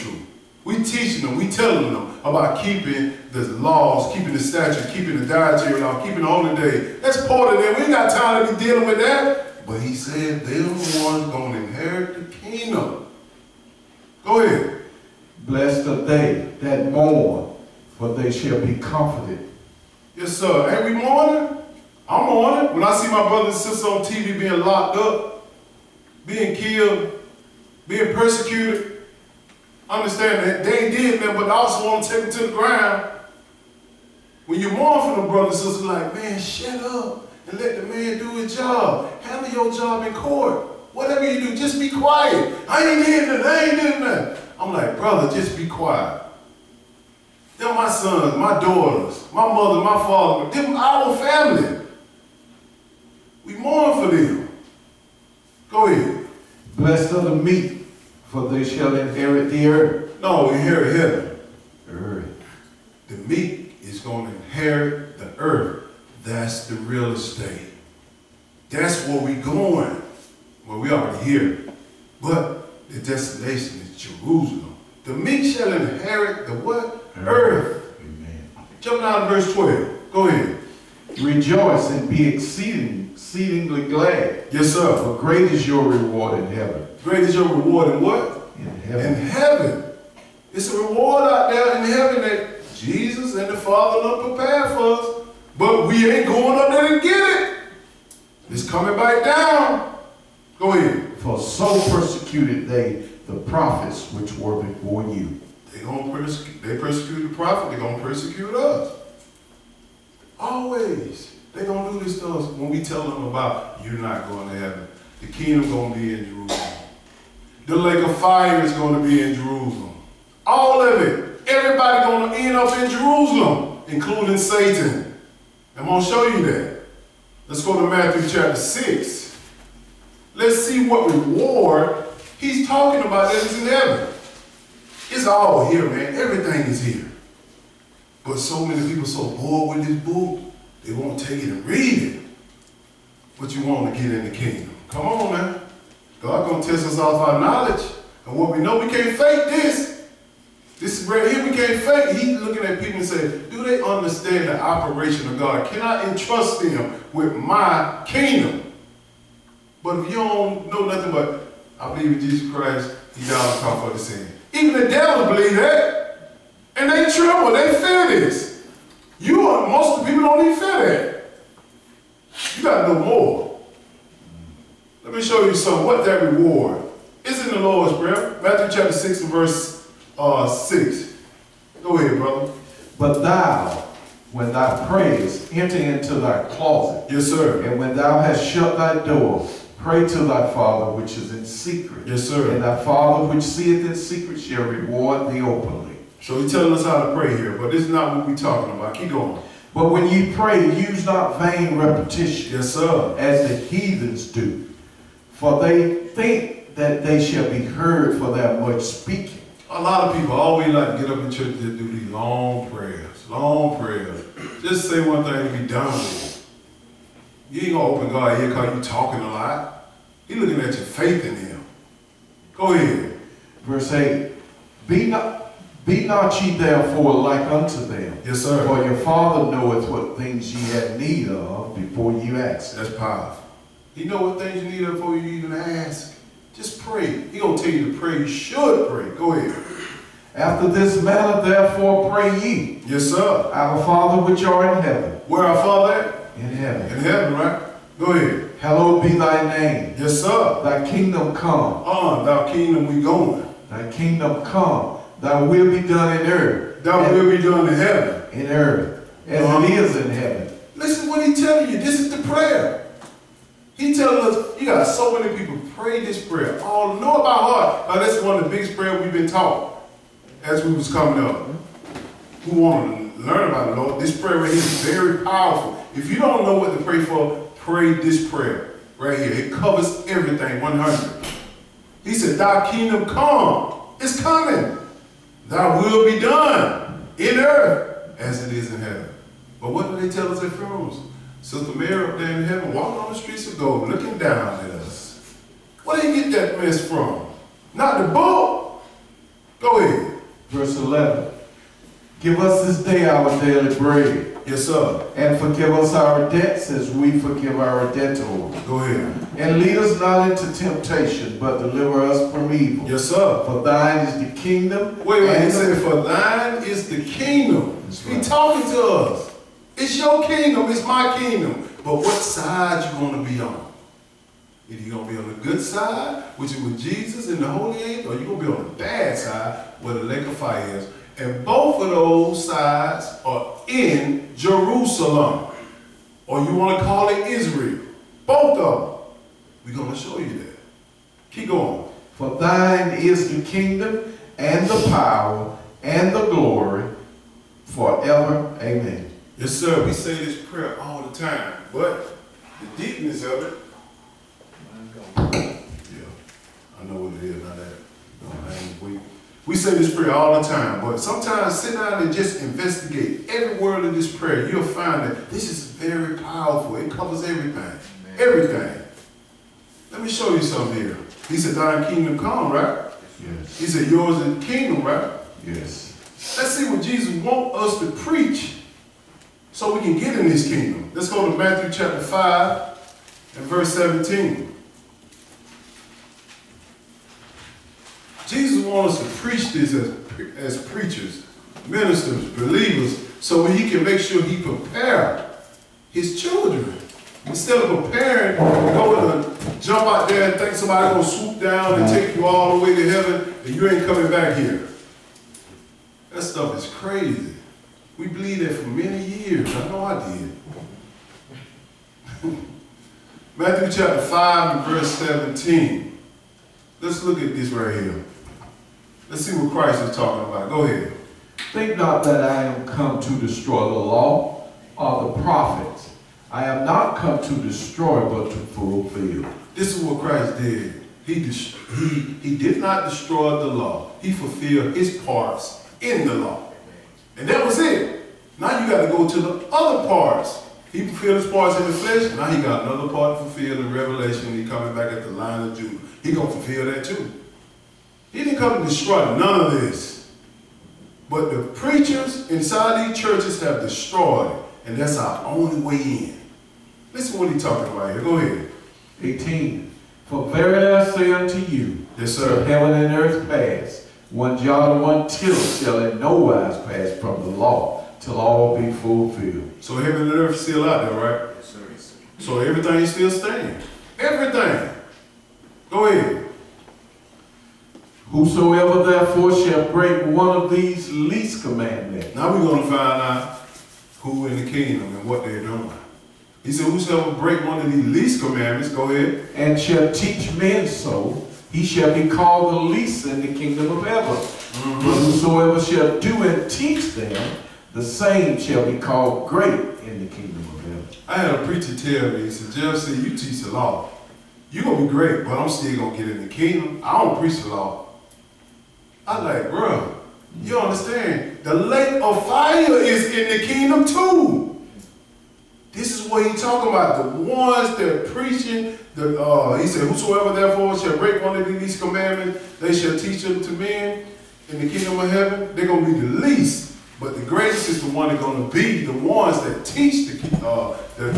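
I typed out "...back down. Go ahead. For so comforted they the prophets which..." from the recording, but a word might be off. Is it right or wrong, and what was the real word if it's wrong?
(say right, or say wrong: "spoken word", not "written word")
wrong: "persecuted", not "comforted".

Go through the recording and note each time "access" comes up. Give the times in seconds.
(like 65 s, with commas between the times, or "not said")
not said.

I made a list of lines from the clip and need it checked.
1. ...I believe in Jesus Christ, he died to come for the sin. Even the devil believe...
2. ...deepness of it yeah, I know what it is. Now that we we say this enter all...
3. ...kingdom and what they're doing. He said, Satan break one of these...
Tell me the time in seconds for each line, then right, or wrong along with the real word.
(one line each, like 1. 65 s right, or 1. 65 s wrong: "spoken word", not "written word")
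1. 161 s right
2. 352 s wrong: "prayer", not "enter"
3. 484 s wrong: "Whosoever", not "Satan".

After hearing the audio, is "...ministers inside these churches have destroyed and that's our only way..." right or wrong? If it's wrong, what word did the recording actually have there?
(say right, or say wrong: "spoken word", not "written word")
wrong: "preachers", not "ministers".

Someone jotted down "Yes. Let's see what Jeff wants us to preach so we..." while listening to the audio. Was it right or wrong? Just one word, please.
wrong.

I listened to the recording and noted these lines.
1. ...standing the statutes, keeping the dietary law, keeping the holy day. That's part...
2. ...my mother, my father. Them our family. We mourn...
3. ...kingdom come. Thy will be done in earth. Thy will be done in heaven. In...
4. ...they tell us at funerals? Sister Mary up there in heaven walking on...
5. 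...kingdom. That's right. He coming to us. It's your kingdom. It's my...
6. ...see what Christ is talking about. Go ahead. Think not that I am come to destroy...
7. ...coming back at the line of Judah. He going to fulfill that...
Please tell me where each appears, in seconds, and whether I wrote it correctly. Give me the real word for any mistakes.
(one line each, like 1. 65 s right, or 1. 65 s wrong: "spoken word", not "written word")
1. 4 s wrong: "keeping", not "standing"
2. 49 s right
3. 253 s right
4. 290 s right
5. 317 s wrong: "talking", not "coming"
6. 419 s right
7. 444 s right.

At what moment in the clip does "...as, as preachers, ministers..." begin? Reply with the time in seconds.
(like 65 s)
389 s.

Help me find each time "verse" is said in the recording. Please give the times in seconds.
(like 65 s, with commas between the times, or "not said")
79 s, 179 s, 223 s, 300 s, 383 s, 414 s.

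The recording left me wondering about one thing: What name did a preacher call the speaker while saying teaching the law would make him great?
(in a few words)
Jeff.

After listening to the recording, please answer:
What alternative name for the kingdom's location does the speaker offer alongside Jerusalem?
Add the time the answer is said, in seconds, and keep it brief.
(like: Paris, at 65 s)
Israel, at 336 s.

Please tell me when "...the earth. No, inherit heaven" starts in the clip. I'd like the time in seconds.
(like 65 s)
59 s.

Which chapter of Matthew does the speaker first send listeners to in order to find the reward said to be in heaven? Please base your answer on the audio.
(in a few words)
Chapter 6.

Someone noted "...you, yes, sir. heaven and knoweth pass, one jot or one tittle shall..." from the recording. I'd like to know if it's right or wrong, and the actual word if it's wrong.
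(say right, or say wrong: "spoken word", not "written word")
wrong: "earth", not "knoweth".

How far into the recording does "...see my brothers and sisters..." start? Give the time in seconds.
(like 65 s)
22 s.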